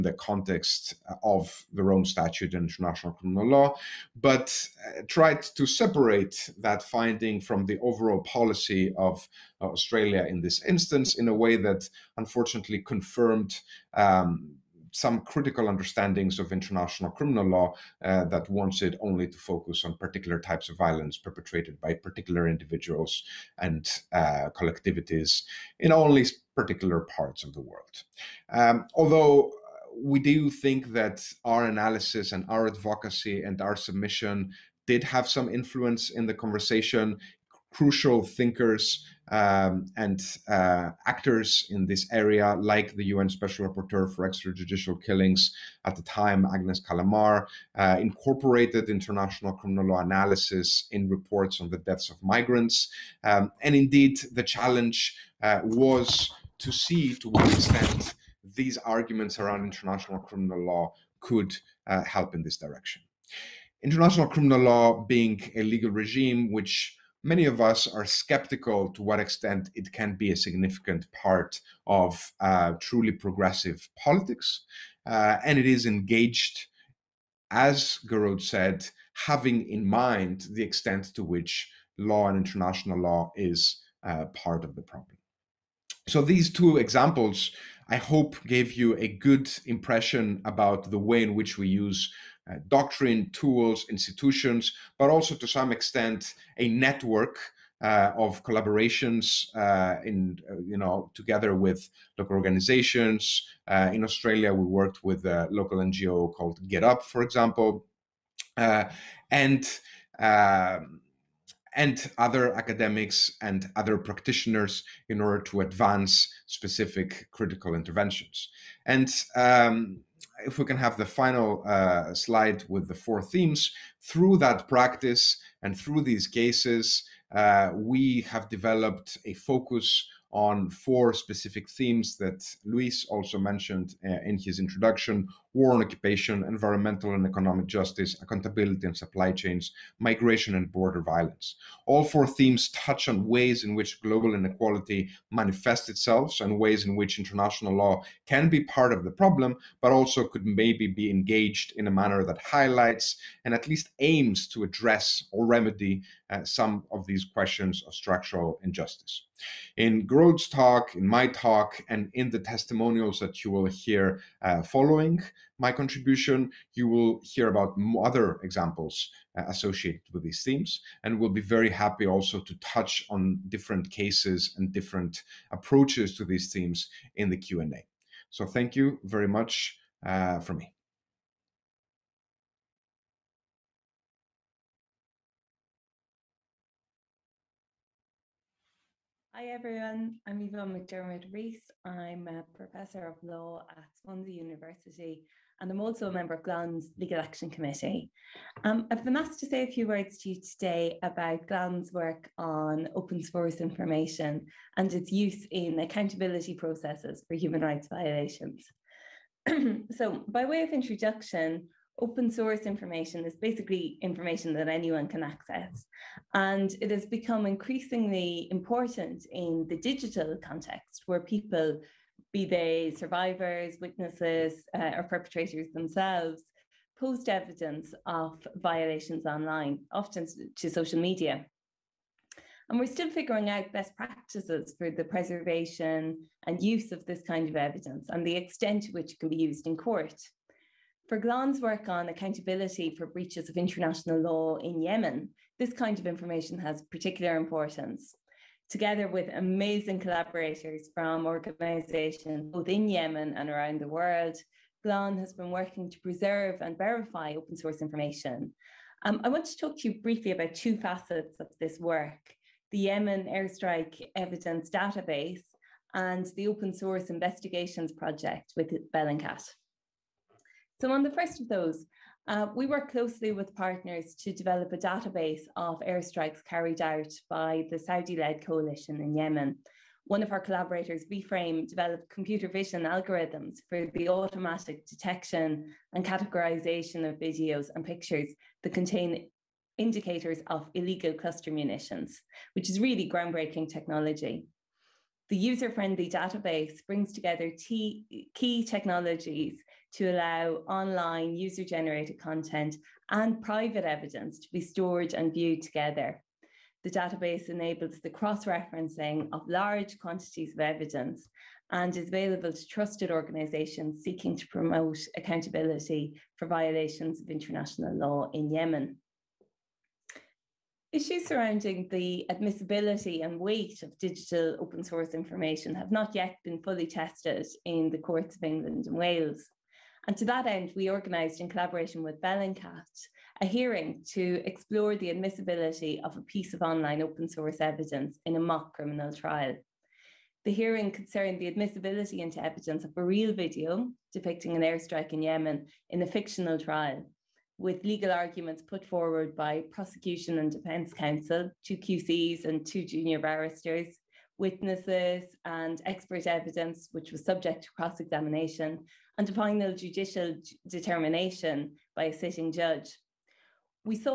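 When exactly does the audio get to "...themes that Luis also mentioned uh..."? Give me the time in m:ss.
2:11.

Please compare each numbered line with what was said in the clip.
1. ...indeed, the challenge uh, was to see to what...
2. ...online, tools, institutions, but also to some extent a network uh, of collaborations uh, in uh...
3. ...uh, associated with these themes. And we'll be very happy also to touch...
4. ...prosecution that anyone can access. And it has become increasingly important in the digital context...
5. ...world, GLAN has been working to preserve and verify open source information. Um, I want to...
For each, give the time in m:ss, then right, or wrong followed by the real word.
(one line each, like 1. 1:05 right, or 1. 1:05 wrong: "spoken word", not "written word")
1. 0:53 right
2. 1:32 wrong: "doctrine", not "online"
3. 2:49 right
4. 3:34 wrong: "information", not "prosecution"
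5. 4:13 right.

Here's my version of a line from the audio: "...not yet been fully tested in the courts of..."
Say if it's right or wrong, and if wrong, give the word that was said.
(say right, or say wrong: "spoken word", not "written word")
right.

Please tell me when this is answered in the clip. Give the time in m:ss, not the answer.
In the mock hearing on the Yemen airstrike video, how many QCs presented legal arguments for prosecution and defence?
5:51.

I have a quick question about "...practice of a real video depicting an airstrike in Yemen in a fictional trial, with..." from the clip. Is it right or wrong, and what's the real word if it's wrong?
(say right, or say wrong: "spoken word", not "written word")
wrong: "evidence", not "practice".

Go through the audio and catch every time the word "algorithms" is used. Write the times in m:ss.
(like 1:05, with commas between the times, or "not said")
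4:42.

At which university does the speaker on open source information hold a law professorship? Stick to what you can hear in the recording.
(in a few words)
Swansea University.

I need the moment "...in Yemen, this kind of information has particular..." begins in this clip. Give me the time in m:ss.
4:04.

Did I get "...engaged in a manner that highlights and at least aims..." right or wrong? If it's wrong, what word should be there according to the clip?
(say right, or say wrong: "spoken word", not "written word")
right.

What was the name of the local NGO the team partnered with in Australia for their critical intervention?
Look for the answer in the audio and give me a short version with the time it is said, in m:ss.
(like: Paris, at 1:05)
Get Up, at 1:46.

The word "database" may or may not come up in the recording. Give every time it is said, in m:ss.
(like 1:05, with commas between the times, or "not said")
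4:24, 4:34, 4:56, 5:06.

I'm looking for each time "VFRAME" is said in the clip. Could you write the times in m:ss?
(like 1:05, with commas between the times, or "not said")
4:41.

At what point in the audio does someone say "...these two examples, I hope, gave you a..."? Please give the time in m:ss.
1:26.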